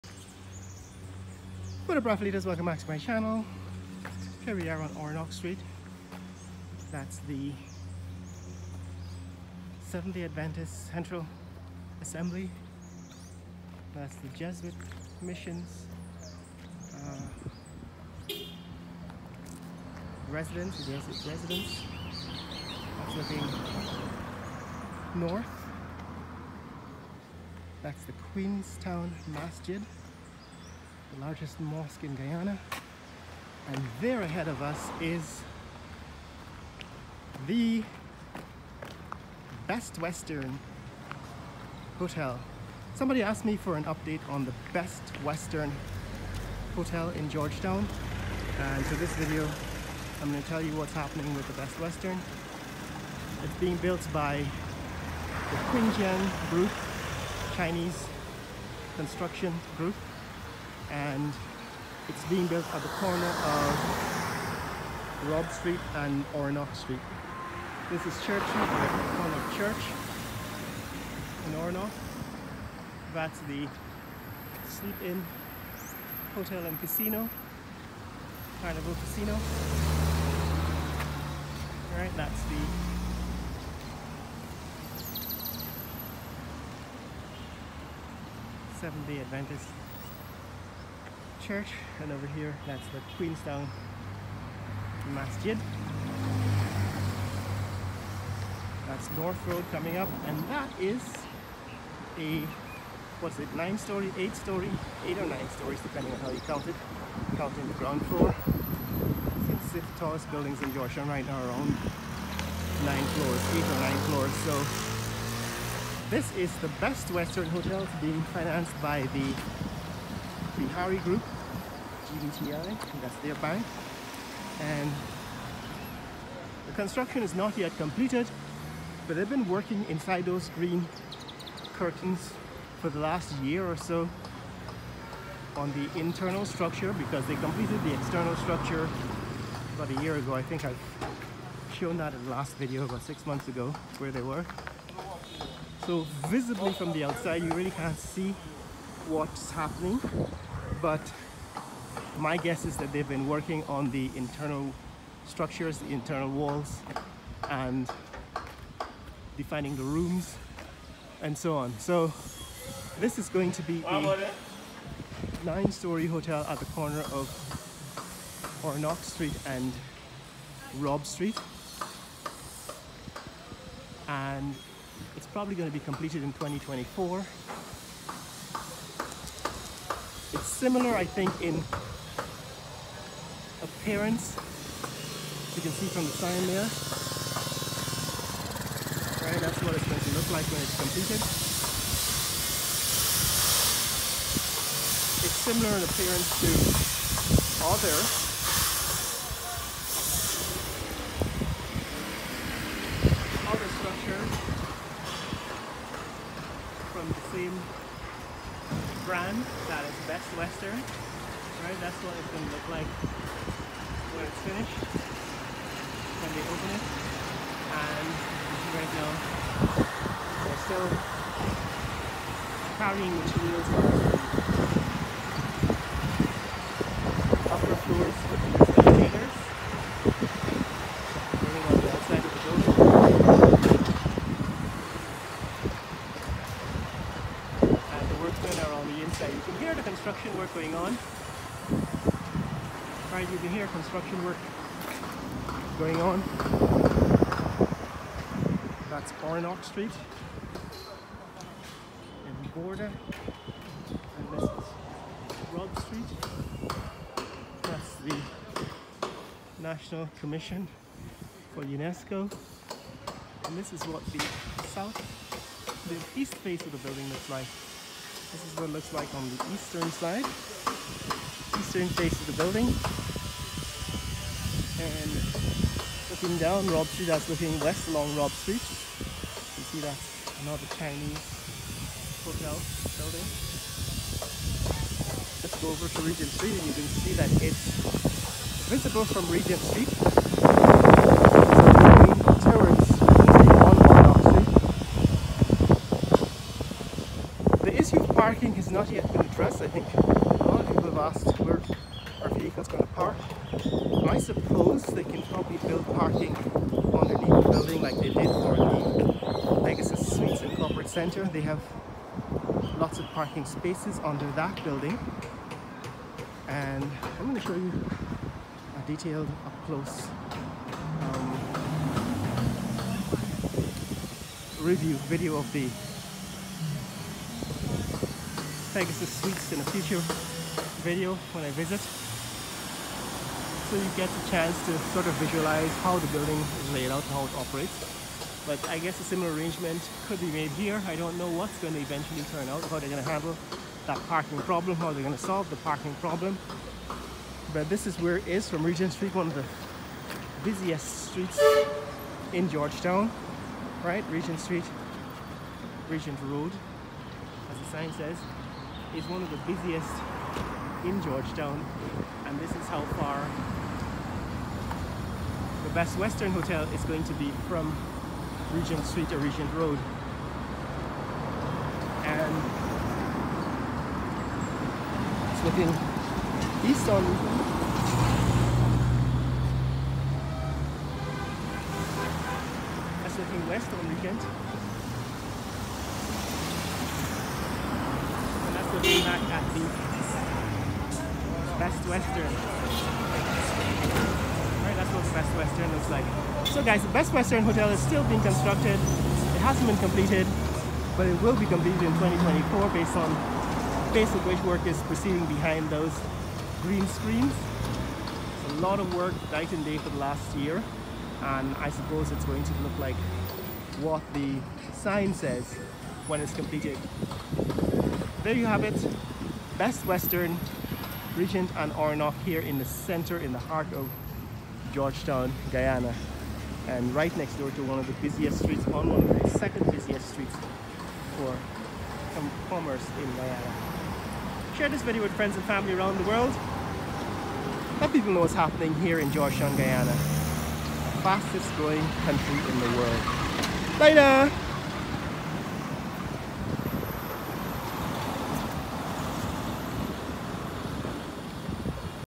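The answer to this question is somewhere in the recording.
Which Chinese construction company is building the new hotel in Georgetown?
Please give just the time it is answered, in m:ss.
0:55.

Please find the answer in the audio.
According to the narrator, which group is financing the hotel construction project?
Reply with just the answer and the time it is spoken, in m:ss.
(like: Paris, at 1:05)
Bihari Group, at 2:00.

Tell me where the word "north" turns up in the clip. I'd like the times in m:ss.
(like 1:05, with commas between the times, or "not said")
0:25, 1:39.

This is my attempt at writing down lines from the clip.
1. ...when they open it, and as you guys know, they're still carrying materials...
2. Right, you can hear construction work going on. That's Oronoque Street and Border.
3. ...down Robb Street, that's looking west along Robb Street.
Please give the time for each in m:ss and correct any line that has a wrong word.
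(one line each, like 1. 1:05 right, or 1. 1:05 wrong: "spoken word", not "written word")
1. 3:34 right
2. 4:03 right
3. 4:36 right.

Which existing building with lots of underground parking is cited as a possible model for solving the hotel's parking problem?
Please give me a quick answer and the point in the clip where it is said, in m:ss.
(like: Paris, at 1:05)
Pegasus Suites and Corporate Center, at 5:09.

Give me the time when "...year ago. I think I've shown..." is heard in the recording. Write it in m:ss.
2:20.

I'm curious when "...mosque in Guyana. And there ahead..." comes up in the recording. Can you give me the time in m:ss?
0:31.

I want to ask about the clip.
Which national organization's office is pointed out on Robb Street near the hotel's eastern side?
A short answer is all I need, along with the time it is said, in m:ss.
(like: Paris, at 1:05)
National Commission for UNESCO, at 4:19.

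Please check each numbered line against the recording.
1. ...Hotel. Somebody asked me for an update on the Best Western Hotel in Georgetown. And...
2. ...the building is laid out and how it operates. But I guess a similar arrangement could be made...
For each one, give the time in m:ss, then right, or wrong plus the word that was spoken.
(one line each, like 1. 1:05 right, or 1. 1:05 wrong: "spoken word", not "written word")
1. 0:41 right
2. 5:35 right.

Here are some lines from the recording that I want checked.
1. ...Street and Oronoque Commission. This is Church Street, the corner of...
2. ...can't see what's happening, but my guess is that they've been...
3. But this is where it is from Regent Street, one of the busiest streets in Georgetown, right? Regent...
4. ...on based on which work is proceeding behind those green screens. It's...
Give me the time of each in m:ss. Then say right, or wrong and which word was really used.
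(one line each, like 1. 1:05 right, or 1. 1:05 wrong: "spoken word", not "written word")
1. 1:05 wrong: "Street", not "Commission"
2. 2:27 right
3. 5:47 right
4. 6:42 right.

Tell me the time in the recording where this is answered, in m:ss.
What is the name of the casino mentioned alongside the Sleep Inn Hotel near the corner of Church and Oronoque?
1:18.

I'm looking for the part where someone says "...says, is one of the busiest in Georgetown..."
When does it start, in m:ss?
5:57.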